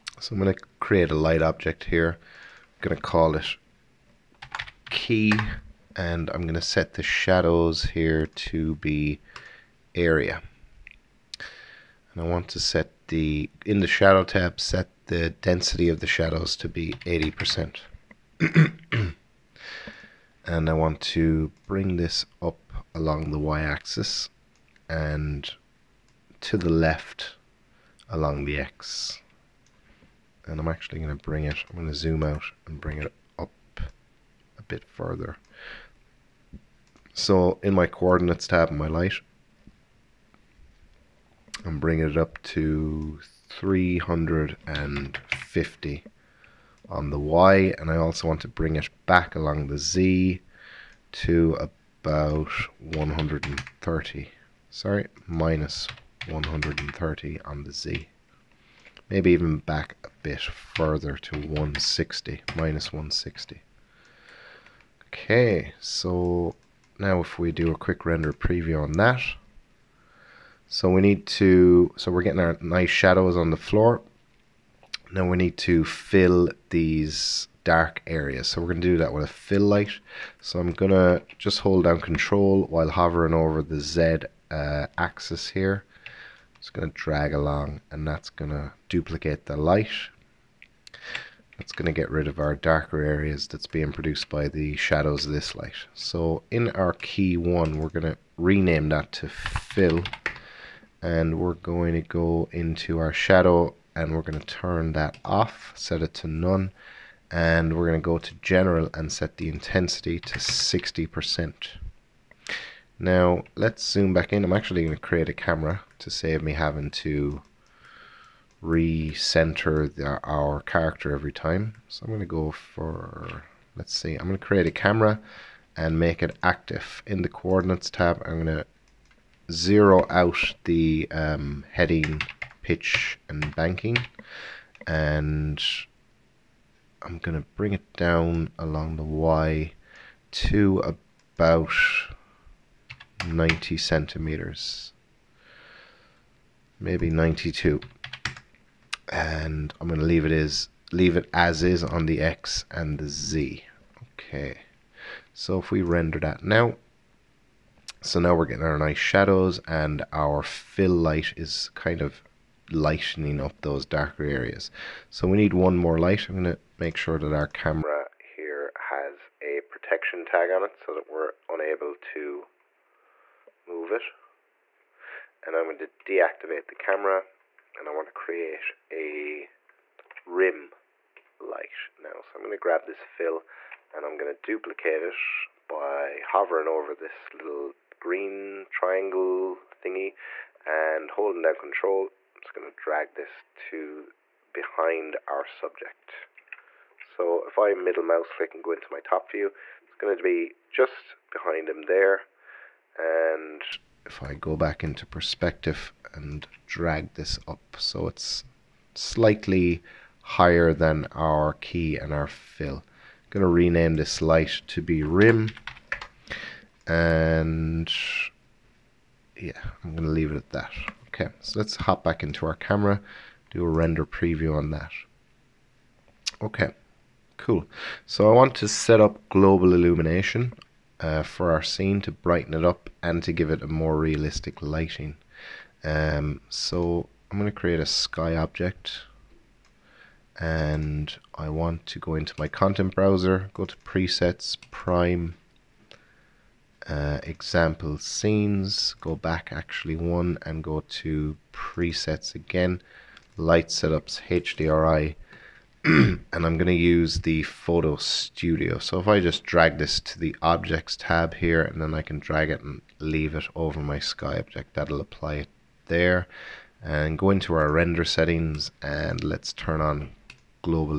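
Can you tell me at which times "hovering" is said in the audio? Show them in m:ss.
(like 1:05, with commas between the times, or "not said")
1:22, 3:06.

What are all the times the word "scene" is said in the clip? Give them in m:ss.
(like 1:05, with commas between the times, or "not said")
3:51, 4:07.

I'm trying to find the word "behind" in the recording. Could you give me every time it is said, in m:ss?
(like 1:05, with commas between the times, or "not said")
3:14, 3:21.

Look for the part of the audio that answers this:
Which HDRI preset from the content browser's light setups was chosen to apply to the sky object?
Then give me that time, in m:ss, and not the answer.
4:17.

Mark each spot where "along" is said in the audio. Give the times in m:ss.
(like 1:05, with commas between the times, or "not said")
0:22, 0:28, 0:49, 1:27, 2:18.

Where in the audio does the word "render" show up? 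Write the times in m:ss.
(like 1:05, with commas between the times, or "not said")
1:08, 2:35, 3:43, 4:27.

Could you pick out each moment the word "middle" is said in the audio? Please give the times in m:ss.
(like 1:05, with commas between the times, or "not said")
3:17.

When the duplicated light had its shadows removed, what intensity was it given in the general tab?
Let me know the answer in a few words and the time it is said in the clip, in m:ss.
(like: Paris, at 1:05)
60%, at 1:50.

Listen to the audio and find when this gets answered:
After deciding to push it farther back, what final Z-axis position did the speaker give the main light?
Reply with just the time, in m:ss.
1:02.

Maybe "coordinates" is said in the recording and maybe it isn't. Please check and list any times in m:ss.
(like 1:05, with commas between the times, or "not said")
0:37, 2:07.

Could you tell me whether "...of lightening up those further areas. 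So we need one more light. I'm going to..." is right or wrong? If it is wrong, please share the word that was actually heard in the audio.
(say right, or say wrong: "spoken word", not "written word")
wrong: "darker", not "further".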